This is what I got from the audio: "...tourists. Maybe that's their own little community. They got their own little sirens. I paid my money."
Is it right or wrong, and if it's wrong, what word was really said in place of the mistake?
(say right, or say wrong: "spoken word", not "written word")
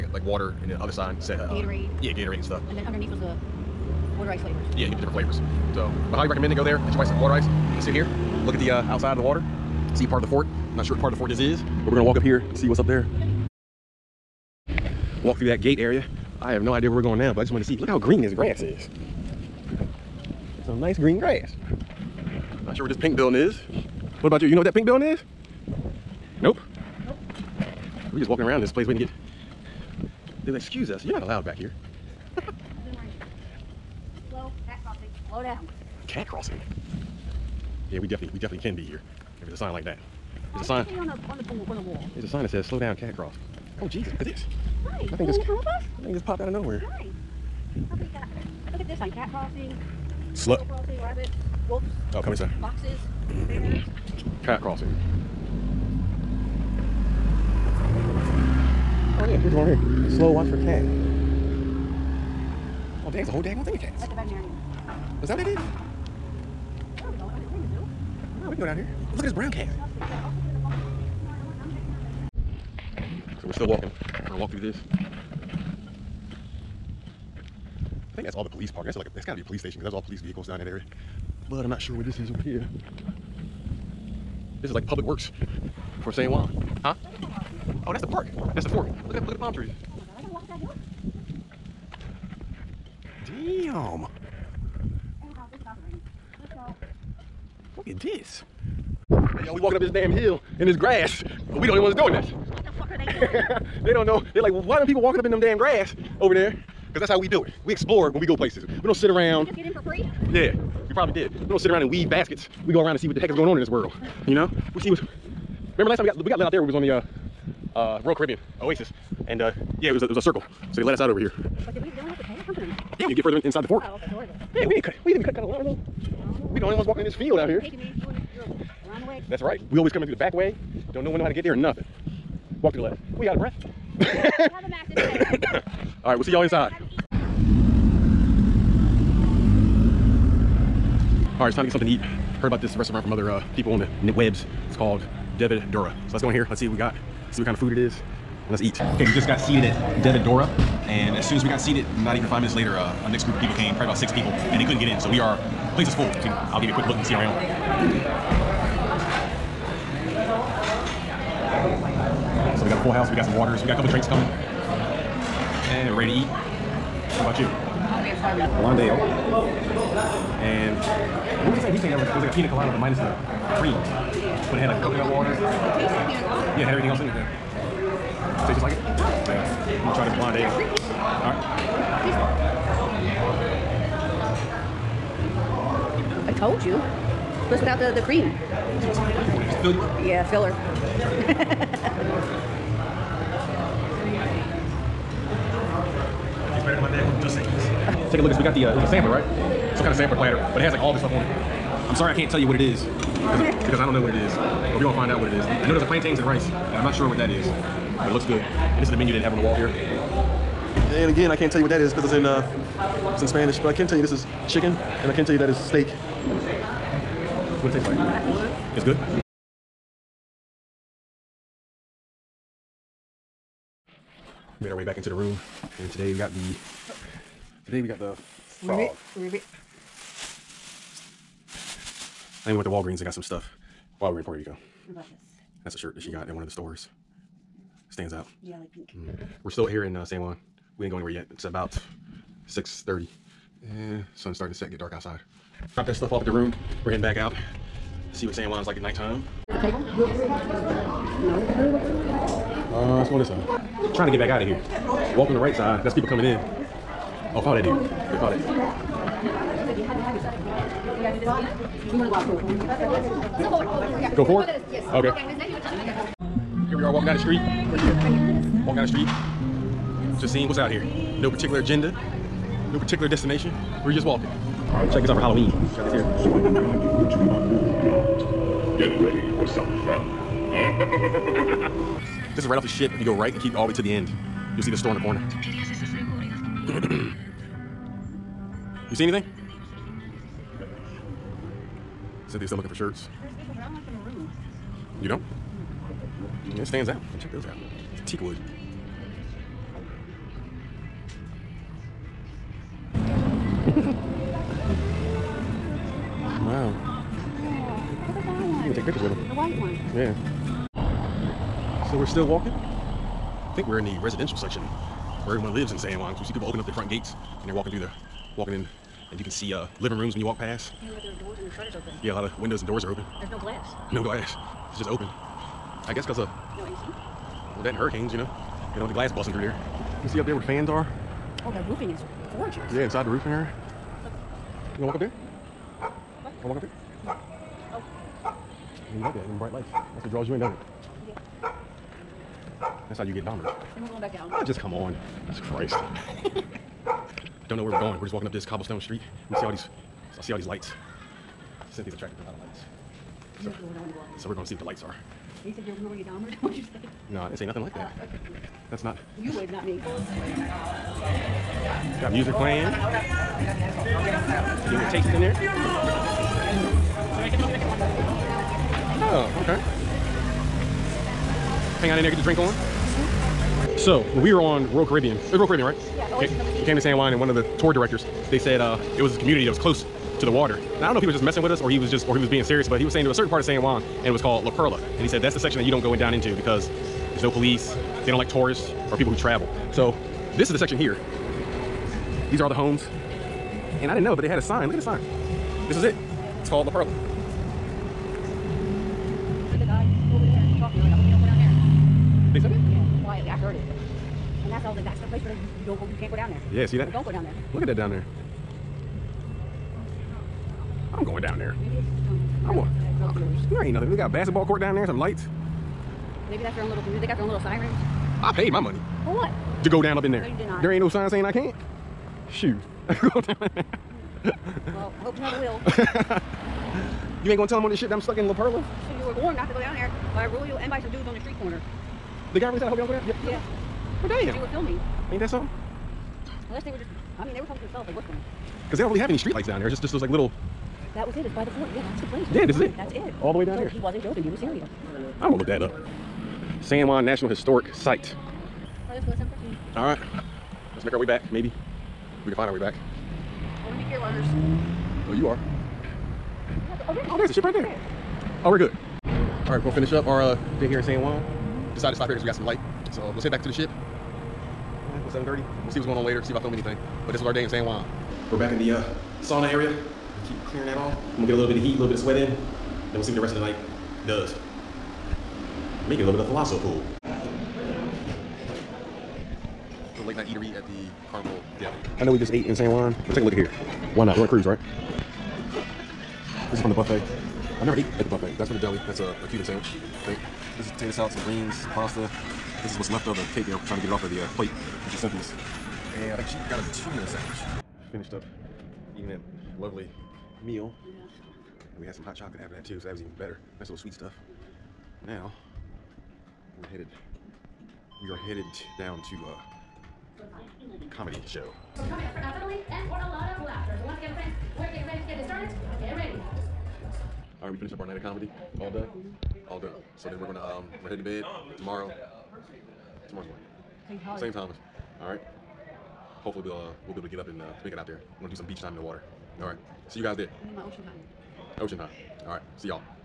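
wrong: "lights", not "tourists".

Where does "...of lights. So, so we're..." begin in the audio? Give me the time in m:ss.
5:52.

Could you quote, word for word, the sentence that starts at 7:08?
You were warned not to go down there by a rule and by some dudes on the street corner.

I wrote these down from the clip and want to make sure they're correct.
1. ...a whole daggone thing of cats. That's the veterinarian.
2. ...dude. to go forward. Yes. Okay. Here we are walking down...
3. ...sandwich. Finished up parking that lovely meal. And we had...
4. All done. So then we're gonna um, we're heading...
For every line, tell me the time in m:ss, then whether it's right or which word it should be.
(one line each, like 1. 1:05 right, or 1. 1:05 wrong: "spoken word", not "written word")
1. 1:03 right
2. 4:18 right
3. 8:17 wrong: "eating", not "parking"
4. 8:39 right.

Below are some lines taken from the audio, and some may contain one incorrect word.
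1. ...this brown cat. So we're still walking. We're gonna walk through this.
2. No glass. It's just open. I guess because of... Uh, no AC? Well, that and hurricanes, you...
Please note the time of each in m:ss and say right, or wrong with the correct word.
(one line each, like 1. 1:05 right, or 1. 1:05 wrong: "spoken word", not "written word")
1. 1:09 right
2. 5:23 right.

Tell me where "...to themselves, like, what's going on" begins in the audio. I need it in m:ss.
7:17.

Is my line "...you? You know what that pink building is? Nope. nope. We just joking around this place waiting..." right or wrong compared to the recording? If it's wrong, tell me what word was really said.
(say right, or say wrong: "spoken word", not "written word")
wrong: "walking", not "joking".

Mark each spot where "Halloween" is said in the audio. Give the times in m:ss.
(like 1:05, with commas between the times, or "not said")
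4:35.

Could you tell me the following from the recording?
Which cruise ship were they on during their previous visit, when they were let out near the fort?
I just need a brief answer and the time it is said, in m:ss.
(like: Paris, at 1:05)
Royal Caribbean Oasis, at 1:58.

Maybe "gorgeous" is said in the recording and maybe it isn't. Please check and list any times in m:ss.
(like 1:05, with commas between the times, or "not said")
5:32.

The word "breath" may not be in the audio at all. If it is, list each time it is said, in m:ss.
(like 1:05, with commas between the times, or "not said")
2:13.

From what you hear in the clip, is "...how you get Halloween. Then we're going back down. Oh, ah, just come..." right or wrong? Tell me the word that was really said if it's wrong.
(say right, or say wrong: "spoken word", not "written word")
wrong: "Dahmer", not "Halloween".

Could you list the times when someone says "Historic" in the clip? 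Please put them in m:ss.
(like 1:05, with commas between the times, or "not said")
7:27.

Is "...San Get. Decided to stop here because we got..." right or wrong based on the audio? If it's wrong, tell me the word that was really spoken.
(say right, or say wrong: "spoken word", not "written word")
wrong: "Juan", not "Get".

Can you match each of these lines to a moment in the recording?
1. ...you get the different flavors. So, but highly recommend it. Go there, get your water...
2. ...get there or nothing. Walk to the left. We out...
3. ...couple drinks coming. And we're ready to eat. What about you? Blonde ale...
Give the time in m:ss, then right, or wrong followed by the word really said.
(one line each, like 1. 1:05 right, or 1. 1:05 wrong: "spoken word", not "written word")
1. 0:04 right
2. 2:11 right
3. 2:43 right.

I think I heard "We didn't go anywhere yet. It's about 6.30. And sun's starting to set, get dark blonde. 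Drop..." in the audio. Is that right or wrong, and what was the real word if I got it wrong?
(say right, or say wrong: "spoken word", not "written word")
wrong: "outside", not "blonde".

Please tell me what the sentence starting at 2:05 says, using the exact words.
we didn't think we cut, cut a line or something?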